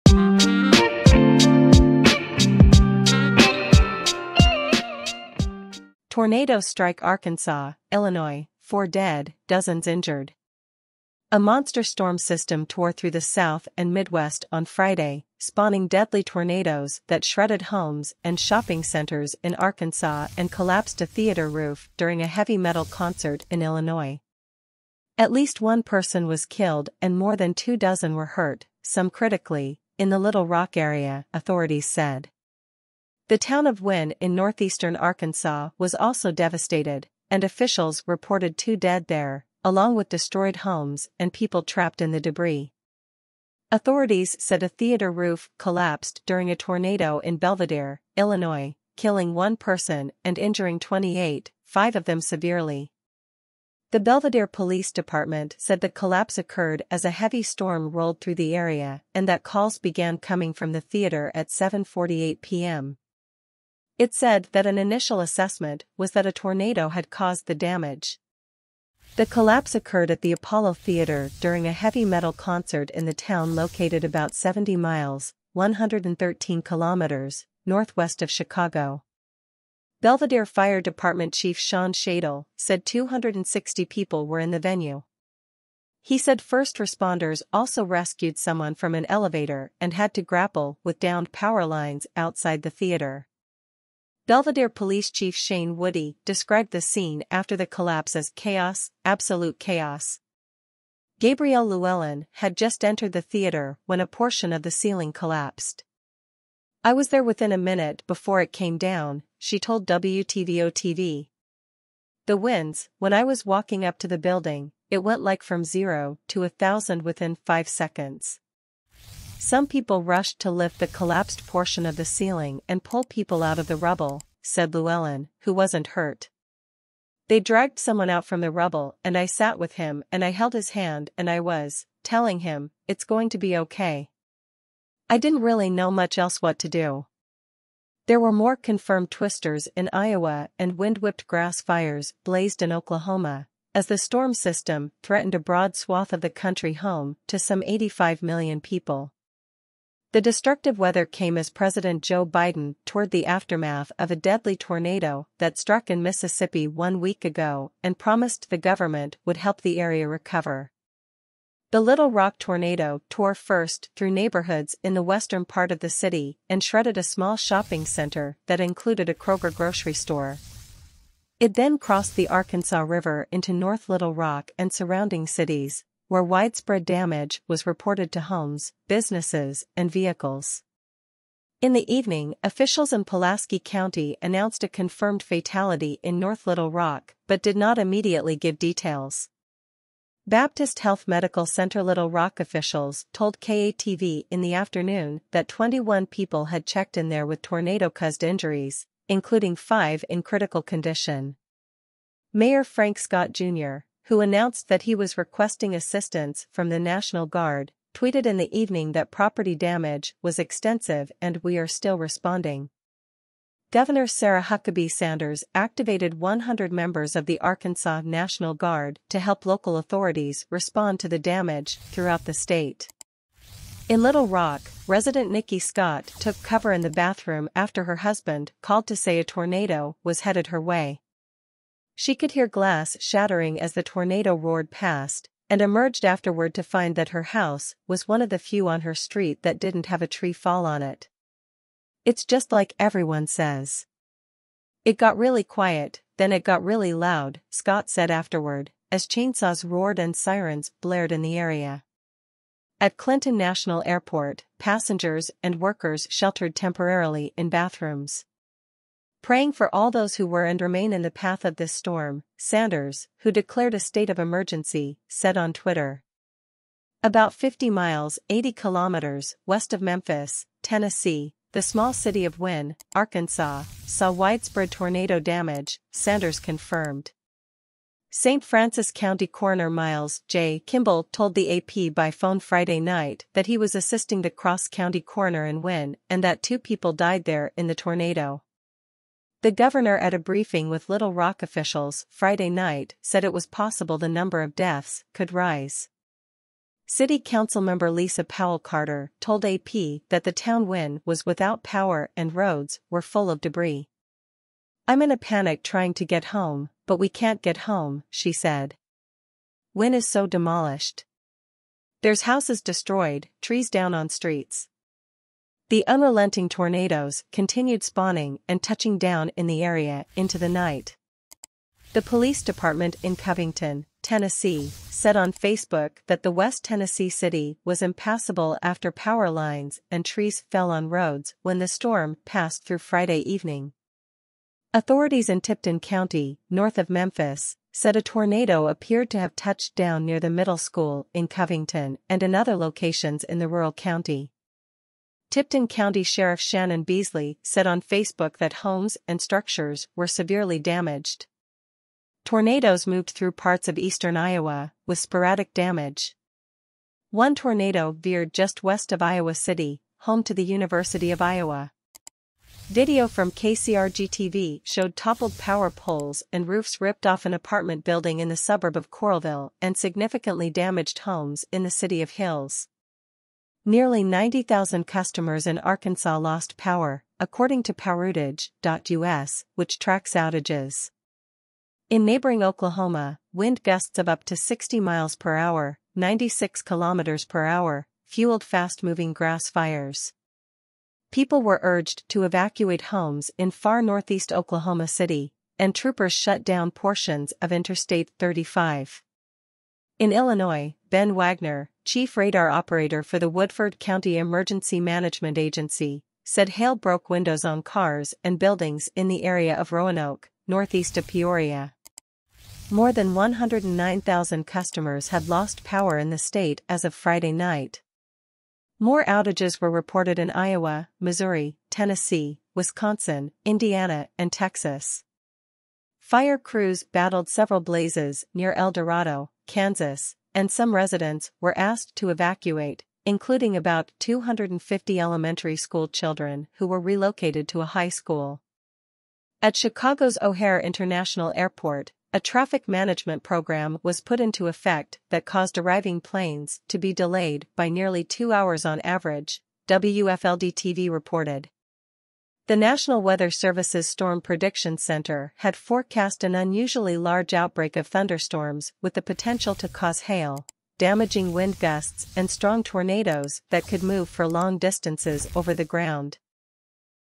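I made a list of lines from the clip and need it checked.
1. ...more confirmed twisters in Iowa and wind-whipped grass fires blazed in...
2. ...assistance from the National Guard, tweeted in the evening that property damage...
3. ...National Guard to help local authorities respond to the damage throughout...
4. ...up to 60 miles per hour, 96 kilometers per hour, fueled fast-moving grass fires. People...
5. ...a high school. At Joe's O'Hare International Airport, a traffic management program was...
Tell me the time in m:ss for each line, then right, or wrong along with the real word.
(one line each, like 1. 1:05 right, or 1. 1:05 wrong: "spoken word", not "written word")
1. 2:18 right
2. 3:25 right
3. 3:38 right
4. 6:24 right
5. 7:17 wrong: "Chicago", not "Joe".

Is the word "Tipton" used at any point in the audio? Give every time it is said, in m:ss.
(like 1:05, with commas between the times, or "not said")
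5:35, 5:45.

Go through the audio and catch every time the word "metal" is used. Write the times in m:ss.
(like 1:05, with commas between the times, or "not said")
0:22, 1:12.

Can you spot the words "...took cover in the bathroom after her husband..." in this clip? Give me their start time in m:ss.
3:46.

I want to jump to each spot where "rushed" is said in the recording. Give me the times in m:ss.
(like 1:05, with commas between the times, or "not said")
2:00.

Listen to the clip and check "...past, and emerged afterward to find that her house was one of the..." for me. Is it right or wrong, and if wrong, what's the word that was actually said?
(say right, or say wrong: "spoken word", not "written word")
right.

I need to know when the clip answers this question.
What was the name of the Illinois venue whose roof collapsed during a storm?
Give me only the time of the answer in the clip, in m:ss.
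1:10.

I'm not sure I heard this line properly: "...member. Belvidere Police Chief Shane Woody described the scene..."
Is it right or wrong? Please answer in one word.
wrong.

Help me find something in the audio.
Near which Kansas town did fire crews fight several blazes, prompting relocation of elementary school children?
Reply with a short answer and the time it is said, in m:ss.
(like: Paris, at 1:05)
El Dorado, at 7:08.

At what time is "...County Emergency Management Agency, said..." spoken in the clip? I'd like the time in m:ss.
6:43.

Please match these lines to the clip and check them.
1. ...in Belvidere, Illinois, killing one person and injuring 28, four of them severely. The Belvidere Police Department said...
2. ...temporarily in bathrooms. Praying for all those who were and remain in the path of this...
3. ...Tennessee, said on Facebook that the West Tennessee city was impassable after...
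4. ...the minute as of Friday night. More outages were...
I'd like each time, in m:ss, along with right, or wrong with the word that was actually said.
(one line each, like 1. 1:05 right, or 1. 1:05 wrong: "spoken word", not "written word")
1. 0:47 wrong: "five", not "four"
2. 4:16 right
3. 5:24 right
4. 6:56 wrong: "state", not "minute".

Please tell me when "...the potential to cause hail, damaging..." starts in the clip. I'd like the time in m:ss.
7:38.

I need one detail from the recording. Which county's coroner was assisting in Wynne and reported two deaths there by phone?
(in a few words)
St. Francis County.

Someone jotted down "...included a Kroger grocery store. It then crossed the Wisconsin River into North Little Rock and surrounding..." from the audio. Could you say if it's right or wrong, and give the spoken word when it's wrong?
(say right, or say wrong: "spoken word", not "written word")
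wrong: "Arkansas", not "Wisconsin".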